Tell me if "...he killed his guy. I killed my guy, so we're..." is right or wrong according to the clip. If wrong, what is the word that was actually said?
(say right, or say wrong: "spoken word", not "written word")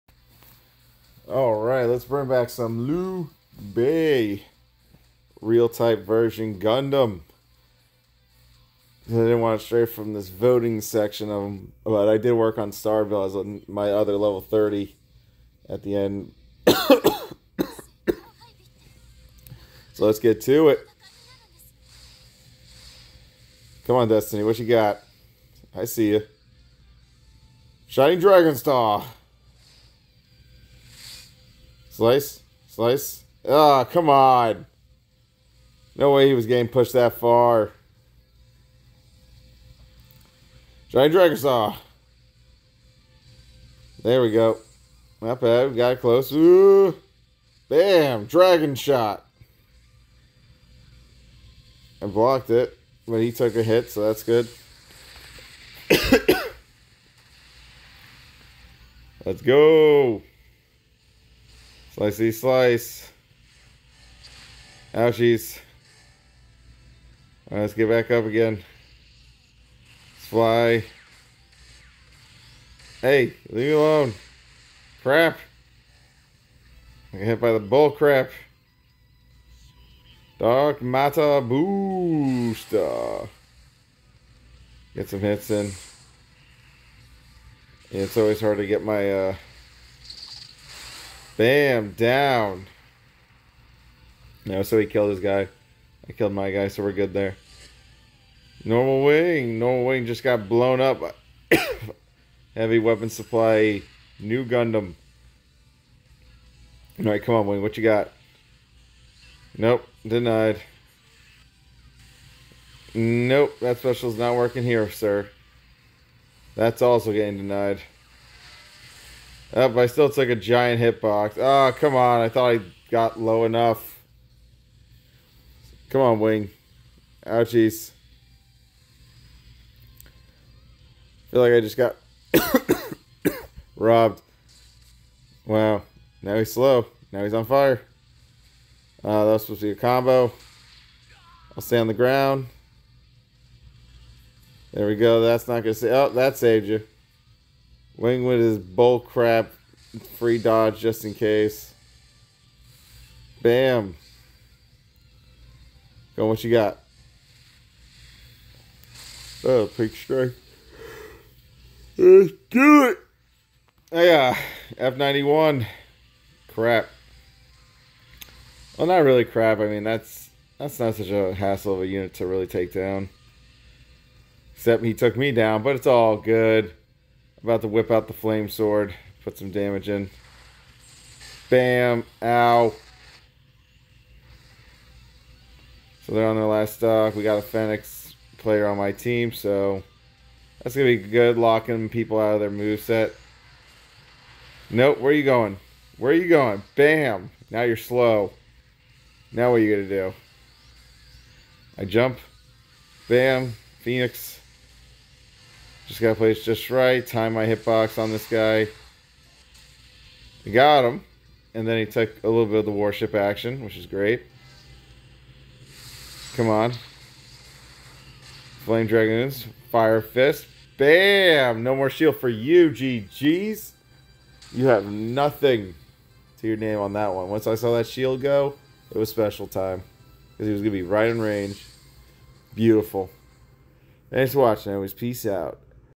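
right.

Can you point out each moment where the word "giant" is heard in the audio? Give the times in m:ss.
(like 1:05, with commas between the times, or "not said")
0:40, 2:00.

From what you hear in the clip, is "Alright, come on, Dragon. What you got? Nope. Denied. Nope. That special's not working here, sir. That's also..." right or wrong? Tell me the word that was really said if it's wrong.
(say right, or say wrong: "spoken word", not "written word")
wrong: "Wing", not "Dragon".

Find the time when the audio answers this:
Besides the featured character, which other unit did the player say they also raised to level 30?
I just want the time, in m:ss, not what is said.
0:12.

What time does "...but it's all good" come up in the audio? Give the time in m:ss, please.
2:55.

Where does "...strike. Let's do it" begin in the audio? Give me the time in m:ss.
2:39.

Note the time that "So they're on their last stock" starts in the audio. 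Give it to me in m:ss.
3:06.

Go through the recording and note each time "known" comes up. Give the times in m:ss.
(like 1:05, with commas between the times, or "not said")
not said.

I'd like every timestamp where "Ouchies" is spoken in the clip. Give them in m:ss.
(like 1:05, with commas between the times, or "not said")
1:04, 2:07.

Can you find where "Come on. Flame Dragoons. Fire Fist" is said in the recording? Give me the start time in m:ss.
3:36.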